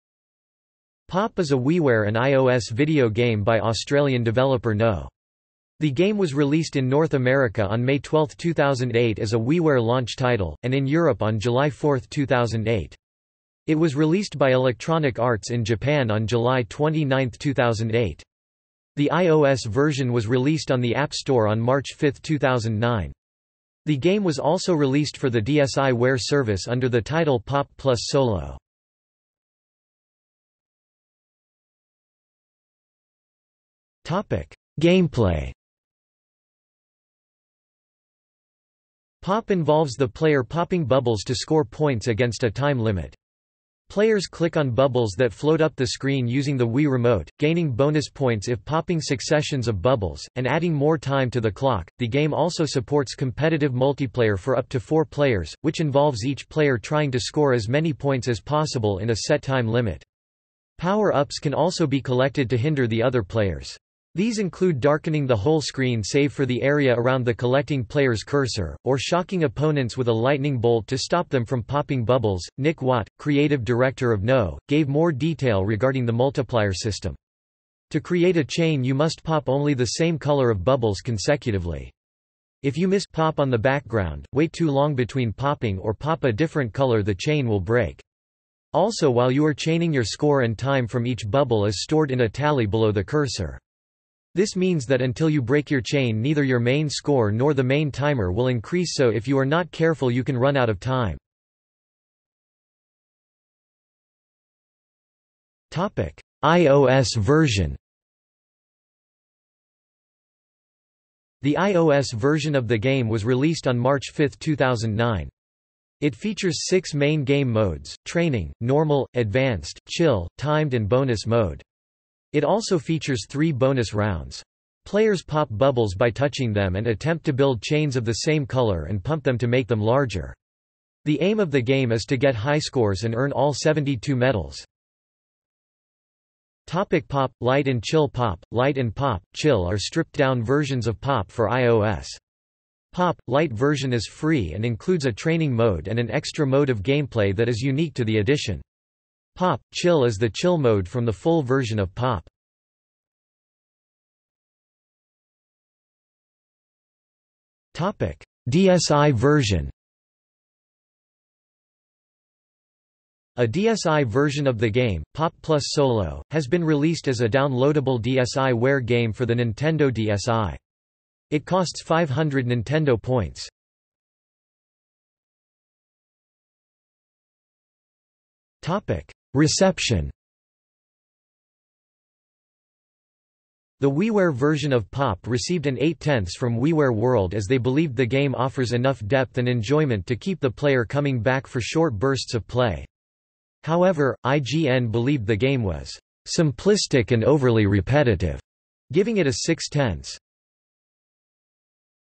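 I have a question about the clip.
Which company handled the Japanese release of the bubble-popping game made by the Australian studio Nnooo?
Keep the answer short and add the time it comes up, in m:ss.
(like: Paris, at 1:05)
Electronic Arts, at 0:14.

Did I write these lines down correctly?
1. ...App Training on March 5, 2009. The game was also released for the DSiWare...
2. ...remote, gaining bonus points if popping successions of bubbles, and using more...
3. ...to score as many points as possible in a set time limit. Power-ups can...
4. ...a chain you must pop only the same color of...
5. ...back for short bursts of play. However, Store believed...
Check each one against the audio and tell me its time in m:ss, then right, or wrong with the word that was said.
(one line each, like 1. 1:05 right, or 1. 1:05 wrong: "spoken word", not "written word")
1. 0:20 wrong: "Store", not "Training"
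2. 0:46 wrong: "adding", not "using"
3. 0:57 right
4. 1:18 right
5. 3:11 wrong: "IGN", not "Store".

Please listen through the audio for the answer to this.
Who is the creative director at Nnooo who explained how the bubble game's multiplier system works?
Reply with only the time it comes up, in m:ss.
1:12.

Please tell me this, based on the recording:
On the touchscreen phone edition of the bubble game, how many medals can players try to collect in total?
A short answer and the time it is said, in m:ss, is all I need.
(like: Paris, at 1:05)
72, at 2:13.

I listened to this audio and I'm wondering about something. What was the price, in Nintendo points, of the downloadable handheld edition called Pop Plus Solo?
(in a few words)
500.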